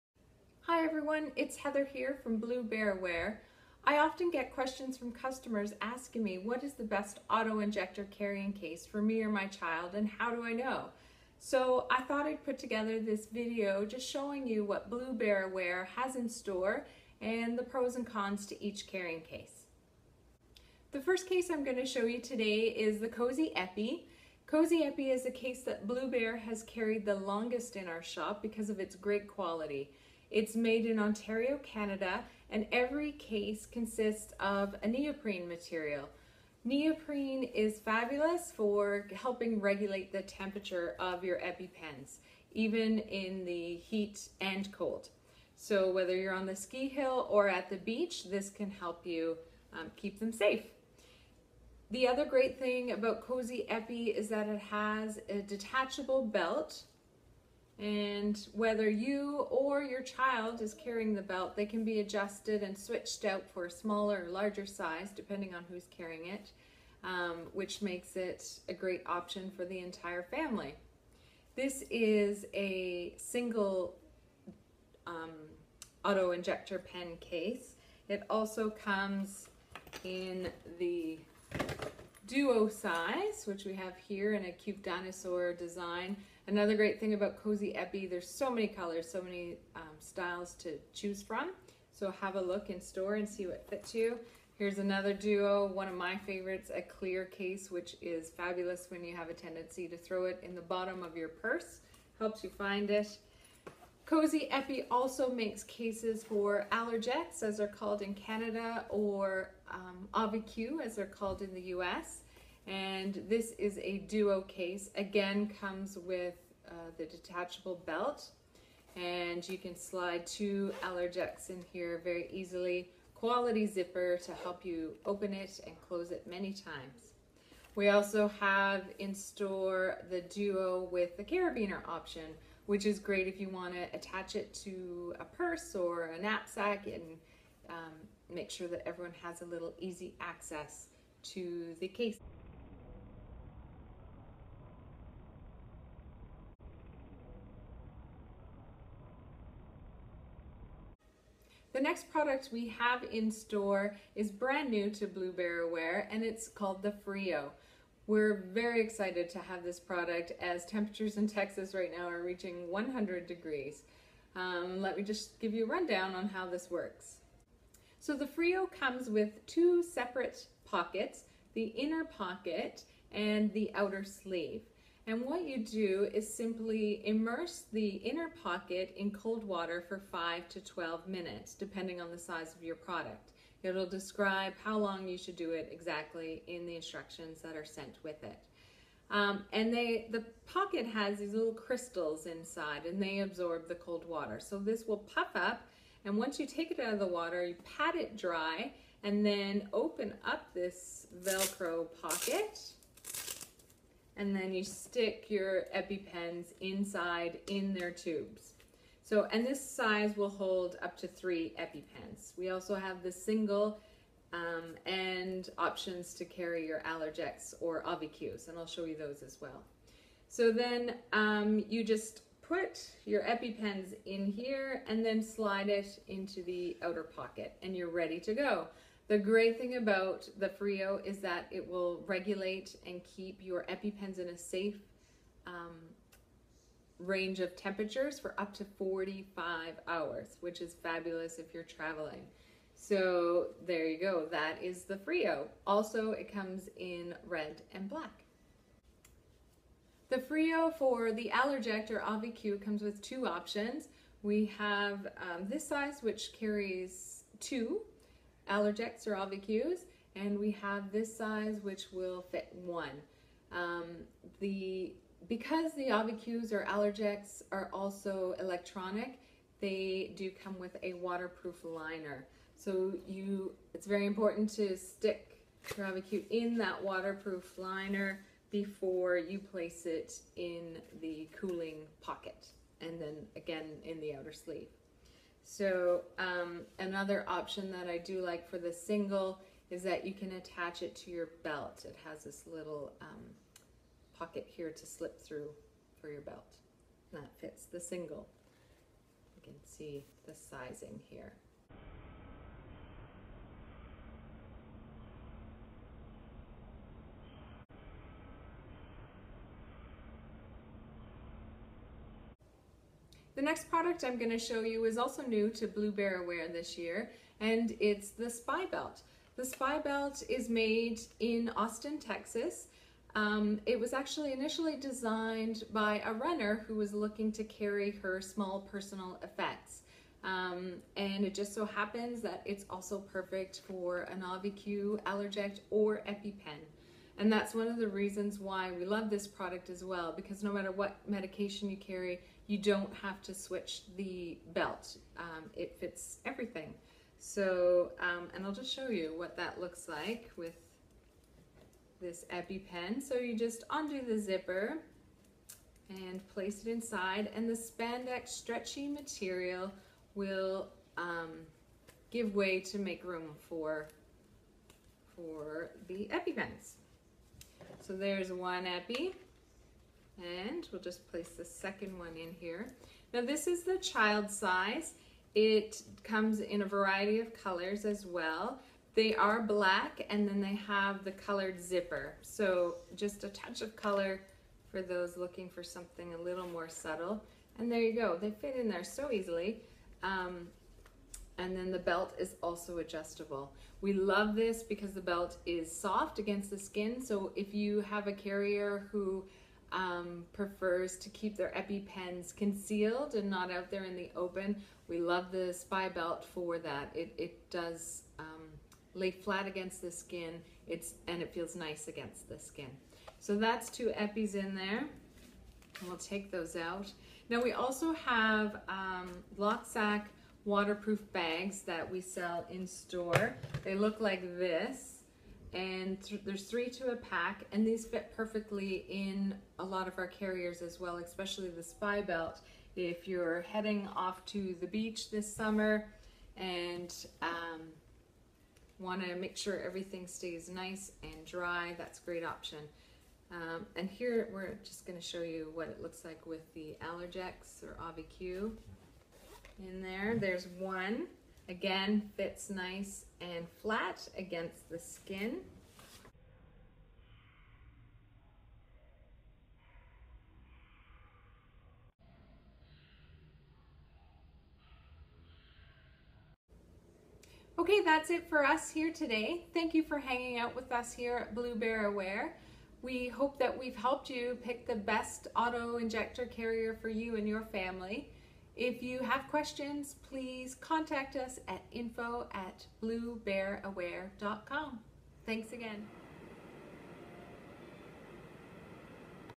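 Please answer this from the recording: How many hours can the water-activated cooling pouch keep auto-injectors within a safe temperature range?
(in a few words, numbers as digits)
45.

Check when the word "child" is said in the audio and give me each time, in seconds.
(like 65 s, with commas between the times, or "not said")
9 s, 60 s, 373 s.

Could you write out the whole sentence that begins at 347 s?
So, um, and I'll just show you what that looks like with this EpiPen.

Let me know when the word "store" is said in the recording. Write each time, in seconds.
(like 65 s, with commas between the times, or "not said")
16 s, 92 s, 129 s, 153 s, 422 s.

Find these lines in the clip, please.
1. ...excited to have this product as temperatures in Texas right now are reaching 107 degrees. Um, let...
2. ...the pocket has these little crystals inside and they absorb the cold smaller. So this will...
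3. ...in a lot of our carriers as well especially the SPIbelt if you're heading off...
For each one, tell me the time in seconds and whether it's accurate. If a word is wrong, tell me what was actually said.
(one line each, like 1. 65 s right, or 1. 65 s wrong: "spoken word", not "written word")
1. 158 s wrong: "100", not "107"
2. 190 s wrong: "water", not "smaller"
3. 428 s right.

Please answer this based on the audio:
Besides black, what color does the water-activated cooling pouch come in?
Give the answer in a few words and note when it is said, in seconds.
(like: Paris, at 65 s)
Red, at 247 s.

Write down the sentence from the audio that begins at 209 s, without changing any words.
So, and this size will hold up to three EpiPens.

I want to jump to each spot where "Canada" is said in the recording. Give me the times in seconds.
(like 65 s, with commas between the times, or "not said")
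31 s, 108 s.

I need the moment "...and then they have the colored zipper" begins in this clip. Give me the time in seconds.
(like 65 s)
380 s.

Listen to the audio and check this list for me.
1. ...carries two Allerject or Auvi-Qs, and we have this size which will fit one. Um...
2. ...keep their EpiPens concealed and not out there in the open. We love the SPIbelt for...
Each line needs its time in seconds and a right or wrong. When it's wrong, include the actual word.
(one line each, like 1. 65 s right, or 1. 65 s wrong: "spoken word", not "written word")
1. 256 s right
2. 401 s right.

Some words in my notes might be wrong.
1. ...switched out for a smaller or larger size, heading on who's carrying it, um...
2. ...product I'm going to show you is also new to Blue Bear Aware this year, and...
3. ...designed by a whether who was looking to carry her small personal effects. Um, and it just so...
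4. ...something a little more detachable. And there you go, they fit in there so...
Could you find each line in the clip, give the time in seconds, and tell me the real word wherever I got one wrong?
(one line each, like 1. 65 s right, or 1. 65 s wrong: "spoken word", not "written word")
1. 62 s wrong: "depending", not "heading"
2. 313 s right
3. 324 s wrong: "runner", not "whether"
4. 385 s wrong: "subtle", not "detachable".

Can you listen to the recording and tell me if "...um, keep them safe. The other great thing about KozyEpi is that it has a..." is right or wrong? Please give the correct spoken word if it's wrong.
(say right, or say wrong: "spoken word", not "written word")
right.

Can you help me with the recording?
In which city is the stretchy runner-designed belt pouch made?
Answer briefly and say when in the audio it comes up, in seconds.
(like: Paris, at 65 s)
Austin, Texas, at 321 s.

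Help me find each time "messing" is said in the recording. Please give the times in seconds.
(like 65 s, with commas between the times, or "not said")
not said.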